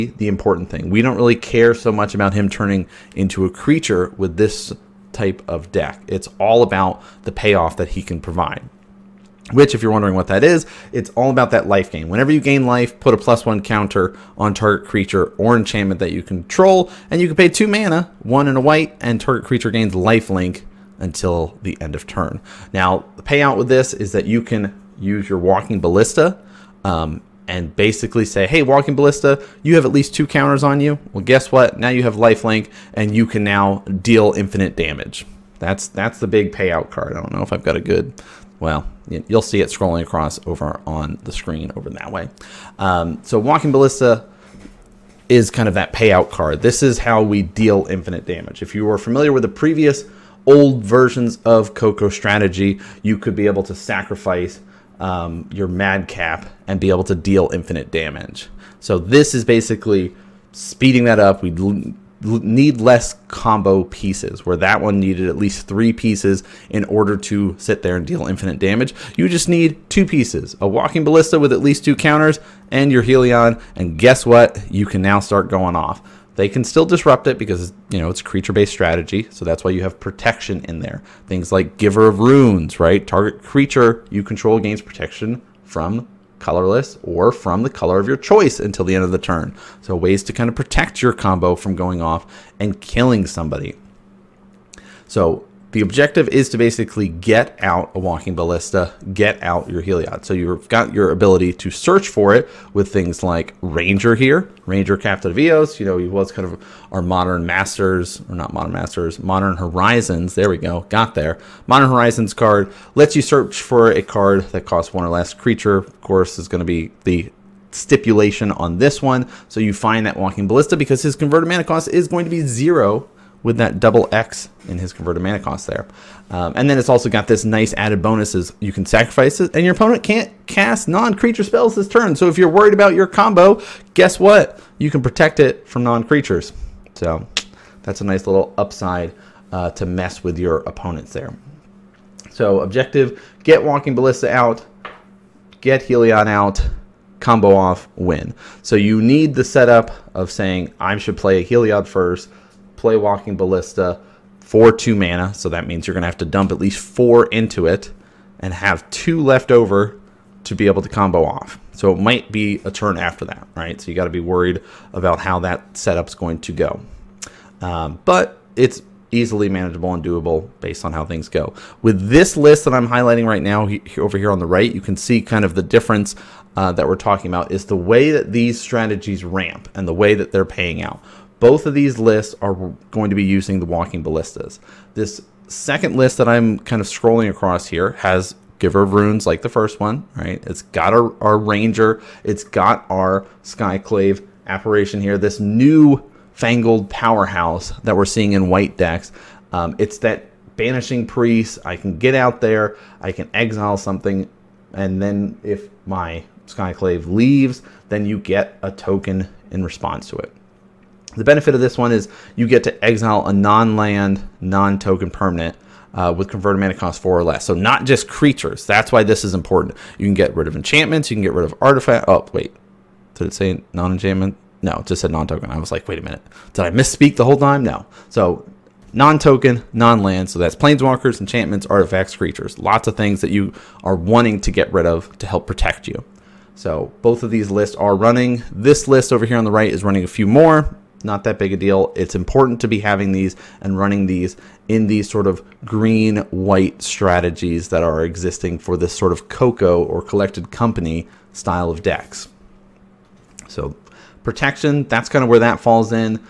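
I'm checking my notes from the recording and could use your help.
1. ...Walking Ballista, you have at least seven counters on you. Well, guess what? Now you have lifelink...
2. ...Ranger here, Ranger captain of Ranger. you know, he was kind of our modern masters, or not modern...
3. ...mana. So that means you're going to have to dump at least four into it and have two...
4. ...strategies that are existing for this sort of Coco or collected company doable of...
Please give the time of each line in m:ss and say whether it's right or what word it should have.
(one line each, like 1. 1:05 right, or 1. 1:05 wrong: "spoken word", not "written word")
1. 0:28 wrong: "two", not "seven"
2. 1:43 wrong: "Eos", not "Ranger"
3. 2:34 right
4. 4:06 wrong: "style", not "doable".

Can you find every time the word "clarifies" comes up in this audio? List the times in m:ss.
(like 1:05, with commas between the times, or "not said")
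not said.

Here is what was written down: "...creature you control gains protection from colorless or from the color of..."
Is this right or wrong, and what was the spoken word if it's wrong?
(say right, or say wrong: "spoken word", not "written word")
right.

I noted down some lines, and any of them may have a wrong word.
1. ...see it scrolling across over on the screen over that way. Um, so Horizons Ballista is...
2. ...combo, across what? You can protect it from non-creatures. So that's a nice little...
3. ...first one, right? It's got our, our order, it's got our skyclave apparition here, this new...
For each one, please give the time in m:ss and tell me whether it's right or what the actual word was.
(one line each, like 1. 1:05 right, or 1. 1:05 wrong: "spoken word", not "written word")
1. 0:39 wrong: "Walking", not "Horizons"
2. 2:13 wrong: "guess", not "across"
3. 3:09 wrong: "ranger", not "order".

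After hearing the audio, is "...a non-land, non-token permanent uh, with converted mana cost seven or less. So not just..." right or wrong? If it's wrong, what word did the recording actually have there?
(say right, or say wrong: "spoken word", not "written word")
wrong: "four", not "seven".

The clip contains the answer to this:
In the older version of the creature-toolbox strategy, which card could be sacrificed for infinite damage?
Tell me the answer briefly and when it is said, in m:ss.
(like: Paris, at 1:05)
madcap, at 0:55.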